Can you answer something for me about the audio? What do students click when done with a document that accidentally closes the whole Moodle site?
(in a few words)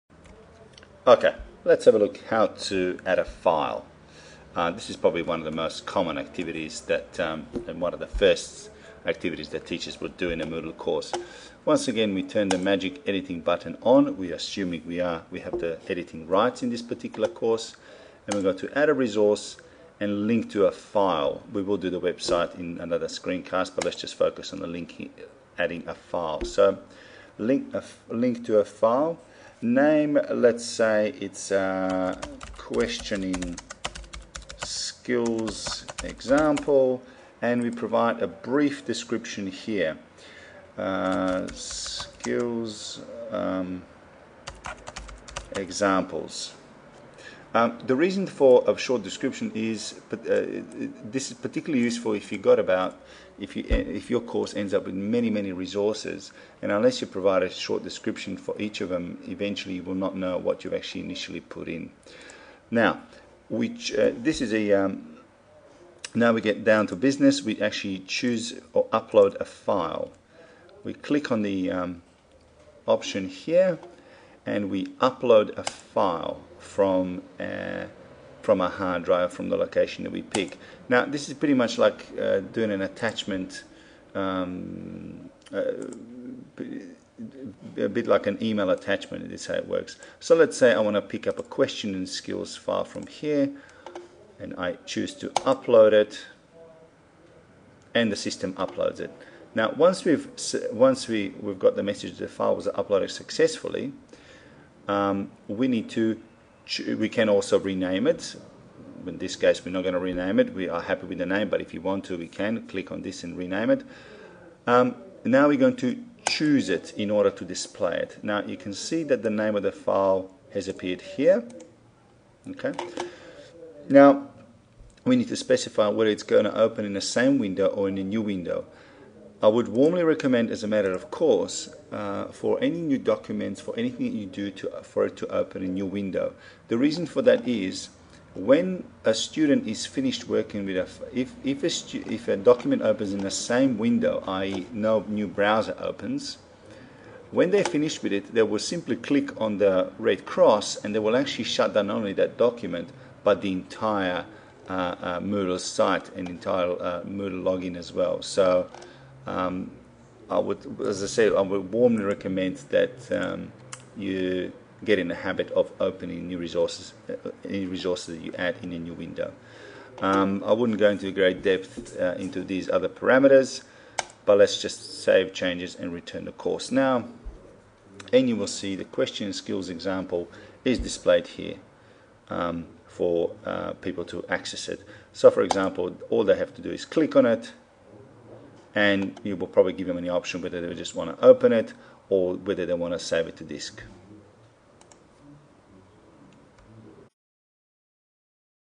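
The red cross.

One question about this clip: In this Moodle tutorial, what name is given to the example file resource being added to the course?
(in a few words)
Questioning skills example.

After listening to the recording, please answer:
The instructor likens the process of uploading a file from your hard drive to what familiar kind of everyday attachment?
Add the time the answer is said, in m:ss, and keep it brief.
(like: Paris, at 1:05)
Email attachment, at 1:28.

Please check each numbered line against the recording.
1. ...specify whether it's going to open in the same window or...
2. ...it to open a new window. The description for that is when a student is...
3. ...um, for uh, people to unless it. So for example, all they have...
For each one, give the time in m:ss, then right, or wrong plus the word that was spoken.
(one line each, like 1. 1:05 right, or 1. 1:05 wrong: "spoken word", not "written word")
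1. 2:05 right
2. 2:15 wrong: "reason", not "description"
3. 3:02 wrong: "access", not "unless".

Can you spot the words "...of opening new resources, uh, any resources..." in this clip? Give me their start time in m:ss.
2:45.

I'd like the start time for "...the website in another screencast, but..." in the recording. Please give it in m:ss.
0:21.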